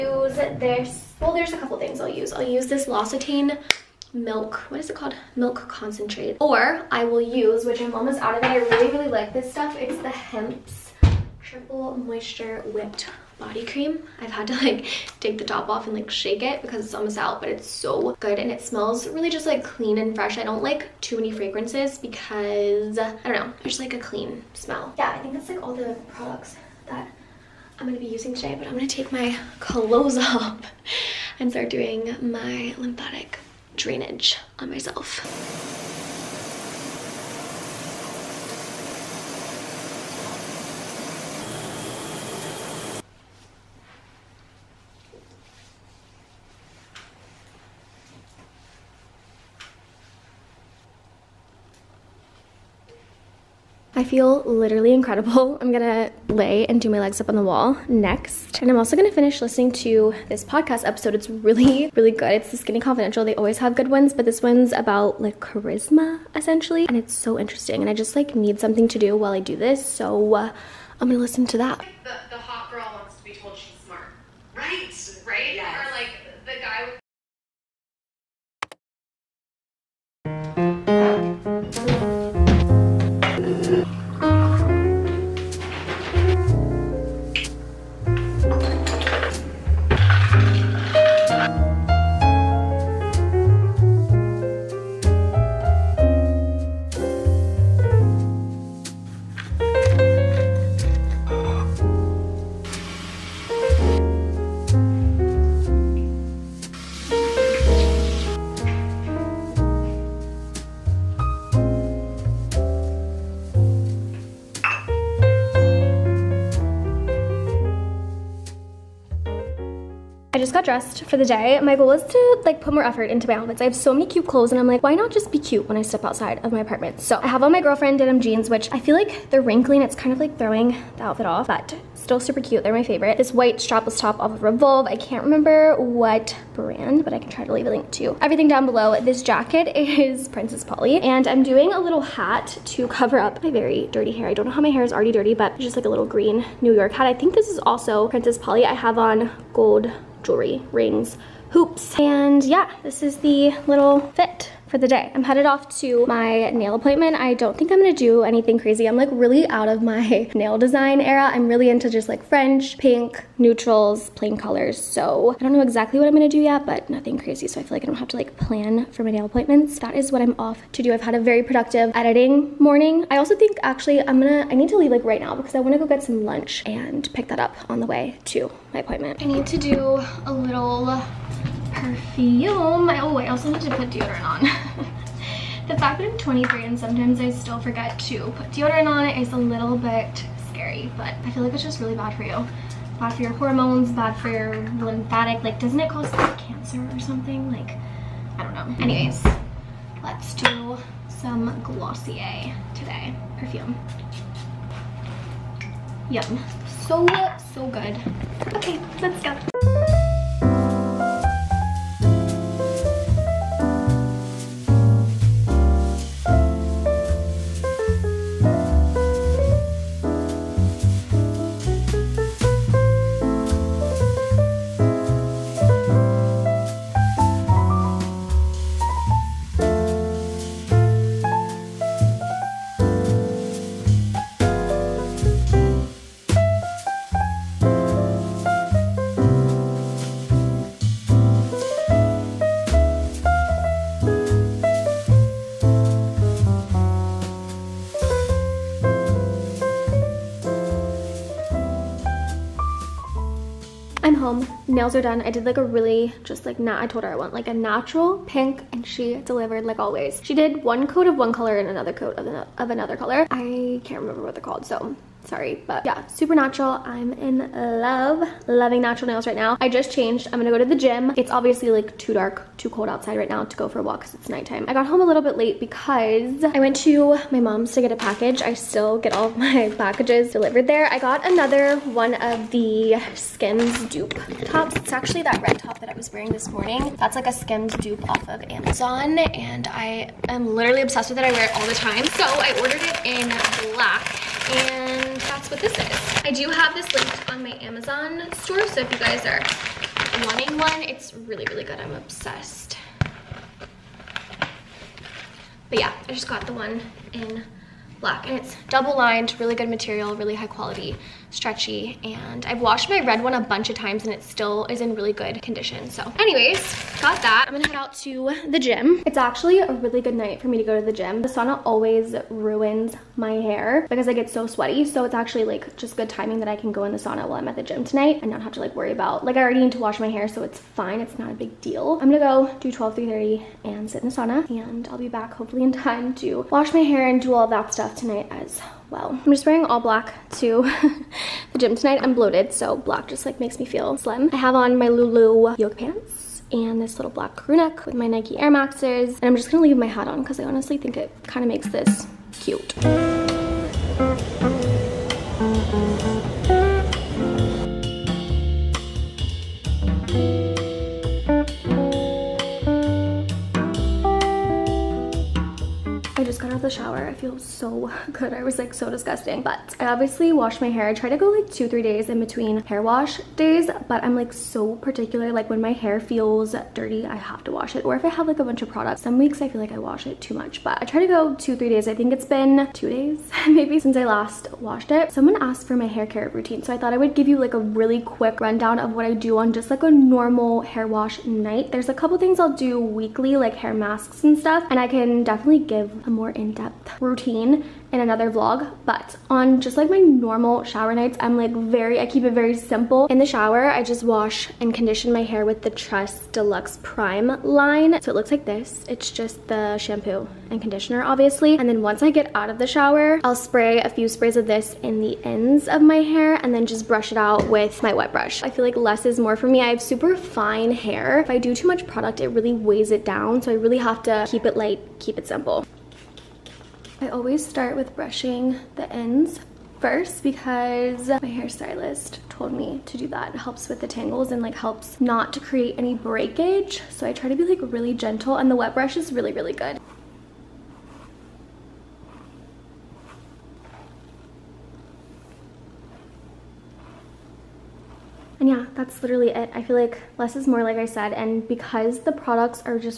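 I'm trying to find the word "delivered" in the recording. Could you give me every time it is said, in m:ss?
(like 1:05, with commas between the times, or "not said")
4:19, 4:40.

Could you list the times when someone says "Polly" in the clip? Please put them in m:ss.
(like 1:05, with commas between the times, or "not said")
2:20, 2:28.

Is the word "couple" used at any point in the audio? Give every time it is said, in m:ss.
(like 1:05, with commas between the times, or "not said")
0:01, 6:31.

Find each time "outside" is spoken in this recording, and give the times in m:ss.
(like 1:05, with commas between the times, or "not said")
2:06, 4:32.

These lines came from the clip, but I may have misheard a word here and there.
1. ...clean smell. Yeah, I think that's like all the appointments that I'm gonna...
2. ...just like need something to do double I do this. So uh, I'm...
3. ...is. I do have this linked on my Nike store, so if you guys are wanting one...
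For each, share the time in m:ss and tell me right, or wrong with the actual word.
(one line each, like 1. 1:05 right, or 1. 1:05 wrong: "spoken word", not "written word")
1. 0:23 wrong: "products", not "appointments"
2. 1:07 wrong: "while", not "double"
3. 4:55 wrong: "Amazon", not "Nike".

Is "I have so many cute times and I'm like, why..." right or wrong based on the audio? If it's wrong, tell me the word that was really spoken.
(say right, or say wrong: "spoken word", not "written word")
wrong: "clothes", not "times".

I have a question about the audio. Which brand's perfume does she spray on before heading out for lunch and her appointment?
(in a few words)
Glossier.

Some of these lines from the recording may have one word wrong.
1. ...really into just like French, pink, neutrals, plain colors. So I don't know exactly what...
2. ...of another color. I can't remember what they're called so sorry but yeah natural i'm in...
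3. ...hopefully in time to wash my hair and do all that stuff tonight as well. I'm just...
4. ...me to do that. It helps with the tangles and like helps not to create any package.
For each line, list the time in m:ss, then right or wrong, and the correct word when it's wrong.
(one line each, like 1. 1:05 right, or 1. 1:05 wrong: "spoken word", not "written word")
1. 2:41 right
2. 4:22 wrong: "supernatural", not "natural"
3. 5:35 right
4. 7:12 wrong: "breakage", not "package".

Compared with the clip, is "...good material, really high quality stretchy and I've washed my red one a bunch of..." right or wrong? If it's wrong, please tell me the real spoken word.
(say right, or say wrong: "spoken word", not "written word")
right.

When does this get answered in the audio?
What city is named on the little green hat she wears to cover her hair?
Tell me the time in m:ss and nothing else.
2:26.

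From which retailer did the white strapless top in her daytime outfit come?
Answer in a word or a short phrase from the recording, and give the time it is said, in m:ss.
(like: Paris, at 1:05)
Revolve, at 2:14.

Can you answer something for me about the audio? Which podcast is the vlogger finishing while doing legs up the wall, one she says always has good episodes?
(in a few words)
The Skinny Confidential.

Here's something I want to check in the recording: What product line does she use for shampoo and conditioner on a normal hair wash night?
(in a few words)
Truss Deluxe Prime.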